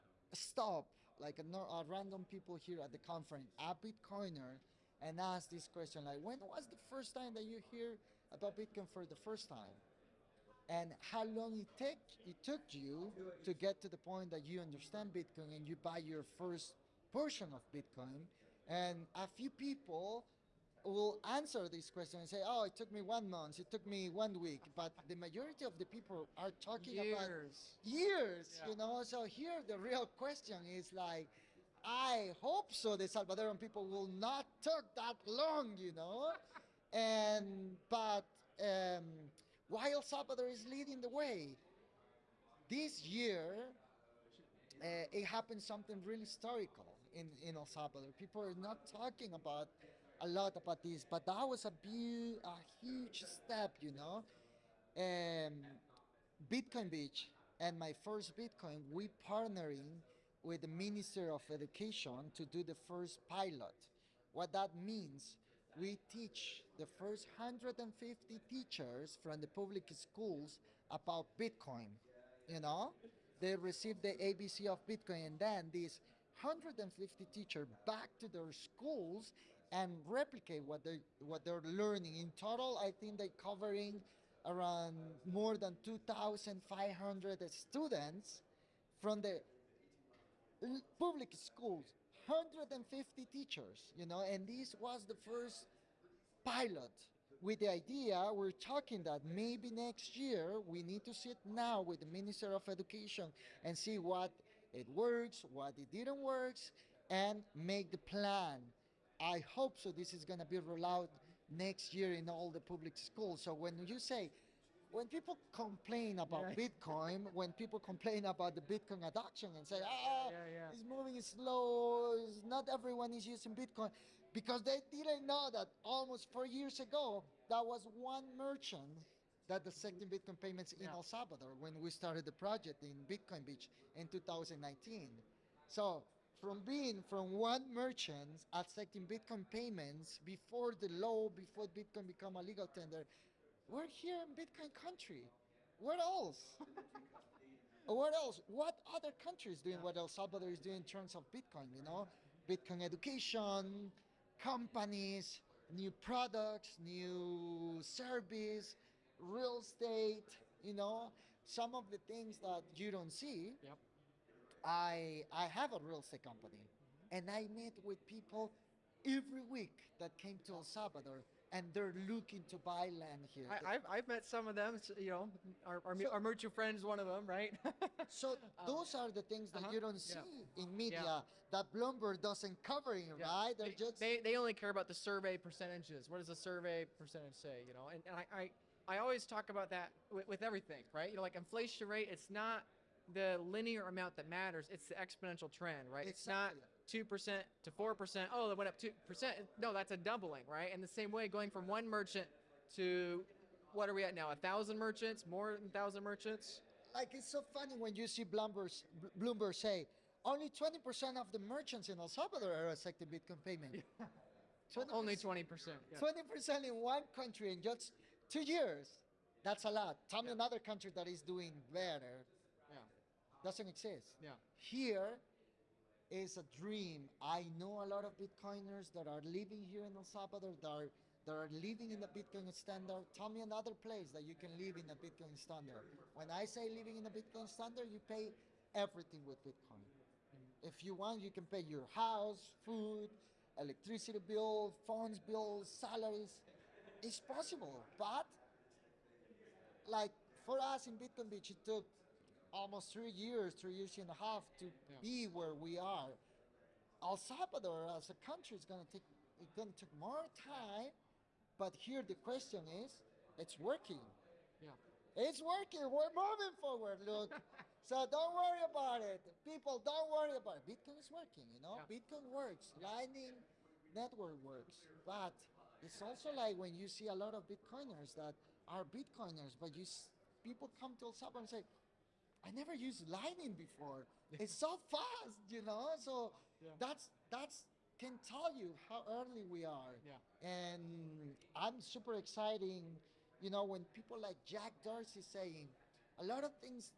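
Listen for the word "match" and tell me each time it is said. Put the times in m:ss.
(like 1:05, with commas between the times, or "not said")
not said.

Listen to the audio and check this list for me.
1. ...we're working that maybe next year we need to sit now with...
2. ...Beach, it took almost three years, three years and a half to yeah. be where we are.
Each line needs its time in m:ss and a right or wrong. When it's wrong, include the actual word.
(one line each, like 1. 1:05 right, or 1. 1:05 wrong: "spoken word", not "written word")
1. 1:38 wrong: "talking", not "working"
2. 4:11 right.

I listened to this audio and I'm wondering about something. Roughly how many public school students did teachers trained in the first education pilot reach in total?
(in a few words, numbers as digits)
2,500.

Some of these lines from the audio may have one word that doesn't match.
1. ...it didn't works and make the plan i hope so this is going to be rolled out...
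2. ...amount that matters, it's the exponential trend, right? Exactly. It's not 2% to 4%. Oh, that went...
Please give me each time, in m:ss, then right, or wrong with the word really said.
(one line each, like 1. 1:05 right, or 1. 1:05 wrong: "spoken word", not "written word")
1. 1:45 right
2. 3:13 right.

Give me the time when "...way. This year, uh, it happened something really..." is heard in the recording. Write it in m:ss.
0:41.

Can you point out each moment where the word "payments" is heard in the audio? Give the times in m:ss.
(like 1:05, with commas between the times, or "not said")
2:10, 2:19, 3:33.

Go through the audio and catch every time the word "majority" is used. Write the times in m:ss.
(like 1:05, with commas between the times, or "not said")
0:25.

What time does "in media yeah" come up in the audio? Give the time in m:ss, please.
3:00.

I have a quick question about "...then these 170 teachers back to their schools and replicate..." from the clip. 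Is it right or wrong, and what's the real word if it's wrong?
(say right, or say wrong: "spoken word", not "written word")
wrong: "150", not "170".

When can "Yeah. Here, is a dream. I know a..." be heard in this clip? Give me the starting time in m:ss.
3:44.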